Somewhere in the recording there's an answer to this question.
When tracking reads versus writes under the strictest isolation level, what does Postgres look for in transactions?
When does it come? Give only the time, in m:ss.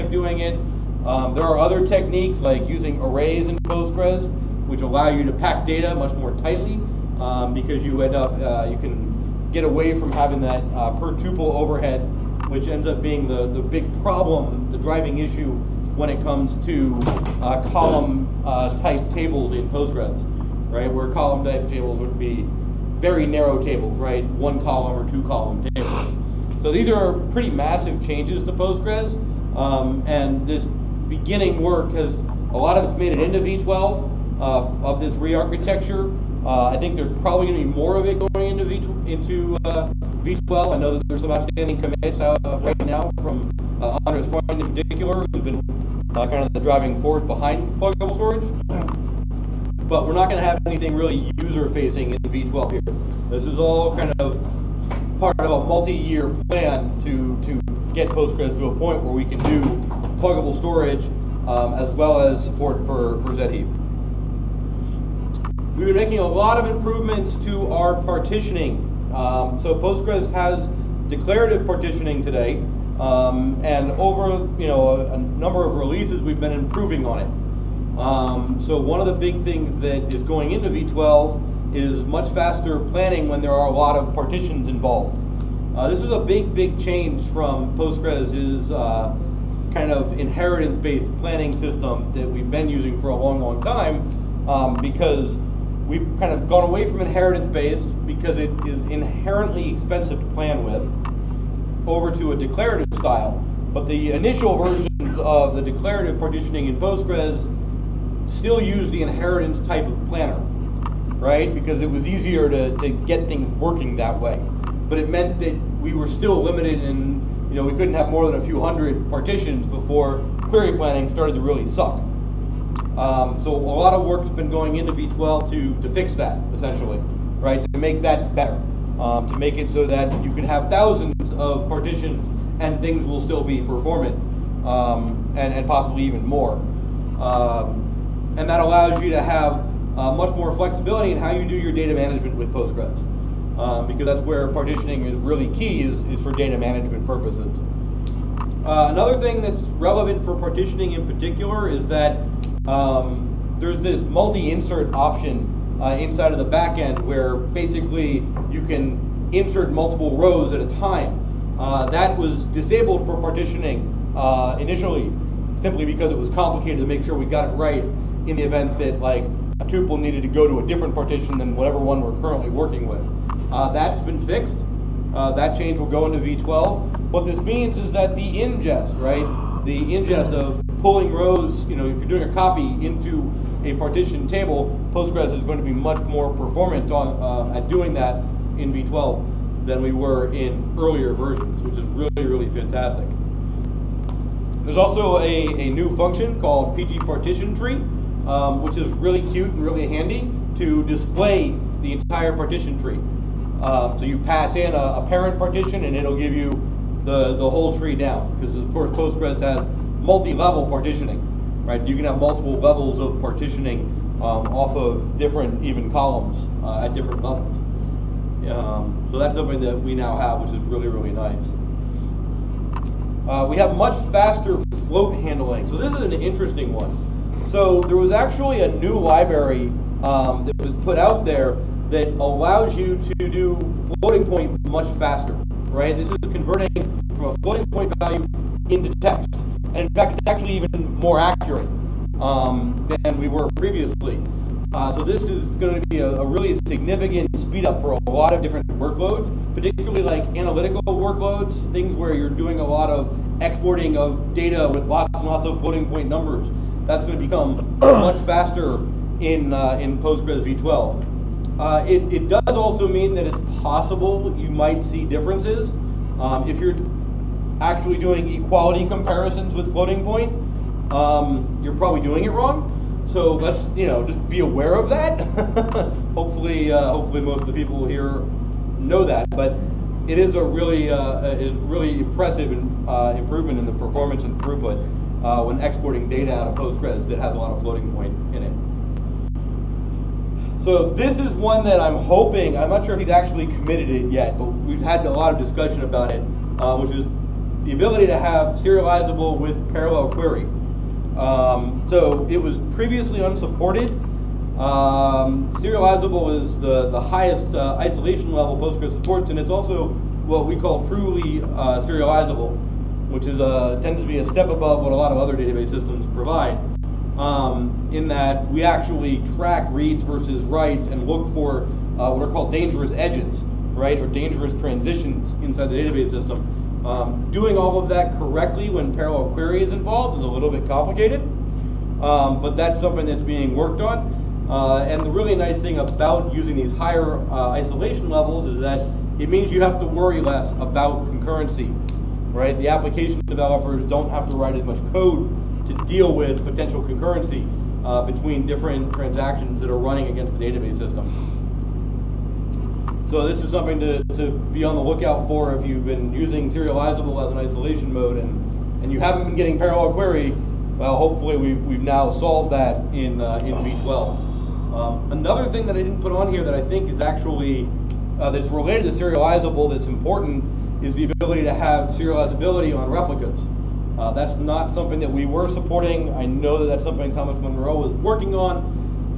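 5:22.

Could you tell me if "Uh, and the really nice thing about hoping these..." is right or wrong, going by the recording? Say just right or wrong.
wrong.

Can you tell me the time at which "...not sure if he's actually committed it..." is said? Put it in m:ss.
4:52.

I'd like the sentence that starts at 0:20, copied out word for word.
Where column type tables would be very narrow tables, right?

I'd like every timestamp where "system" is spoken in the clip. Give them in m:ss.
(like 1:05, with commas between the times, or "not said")
1:31, 5:15, 5:26, 5:50.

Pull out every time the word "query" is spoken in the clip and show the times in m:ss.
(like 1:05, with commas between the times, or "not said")
2:00, 5:00, 5:29, 5:59.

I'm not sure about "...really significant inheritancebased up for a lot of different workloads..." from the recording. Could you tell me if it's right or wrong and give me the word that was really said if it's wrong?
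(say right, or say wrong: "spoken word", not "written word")
wrong: "speed", not "inheritancebased".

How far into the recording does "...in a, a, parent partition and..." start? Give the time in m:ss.
3:24.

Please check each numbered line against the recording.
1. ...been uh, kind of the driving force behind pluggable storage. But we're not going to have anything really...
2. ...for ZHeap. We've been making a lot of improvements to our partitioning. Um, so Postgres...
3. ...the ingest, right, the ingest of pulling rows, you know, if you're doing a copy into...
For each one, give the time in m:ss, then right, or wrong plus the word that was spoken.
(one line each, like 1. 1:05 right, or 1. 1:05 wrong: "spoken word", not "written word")
1. 0:45 right
2. 1:03 right
3. 2:58 right.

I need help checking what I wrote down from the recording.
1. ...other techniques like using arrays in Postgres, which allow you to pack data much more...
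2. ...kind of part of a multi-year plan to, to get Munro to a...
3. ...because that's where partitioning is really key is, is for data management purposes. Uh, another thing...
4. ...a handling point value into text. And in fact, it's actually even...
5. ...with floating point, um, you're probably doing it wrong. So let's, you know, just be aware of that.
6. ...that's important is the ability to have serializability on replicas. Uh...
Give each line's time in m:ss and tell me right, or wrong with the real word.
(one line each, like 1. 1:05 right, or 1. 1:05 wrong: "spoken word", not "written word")
1. 0:01 right
2. 0:53 wrong: "Postgres", not "Munro"
3. 2:23 right
4. 3:57 wrong: "floating", not "handling"
5. 4:29 right
6. 6:09 right.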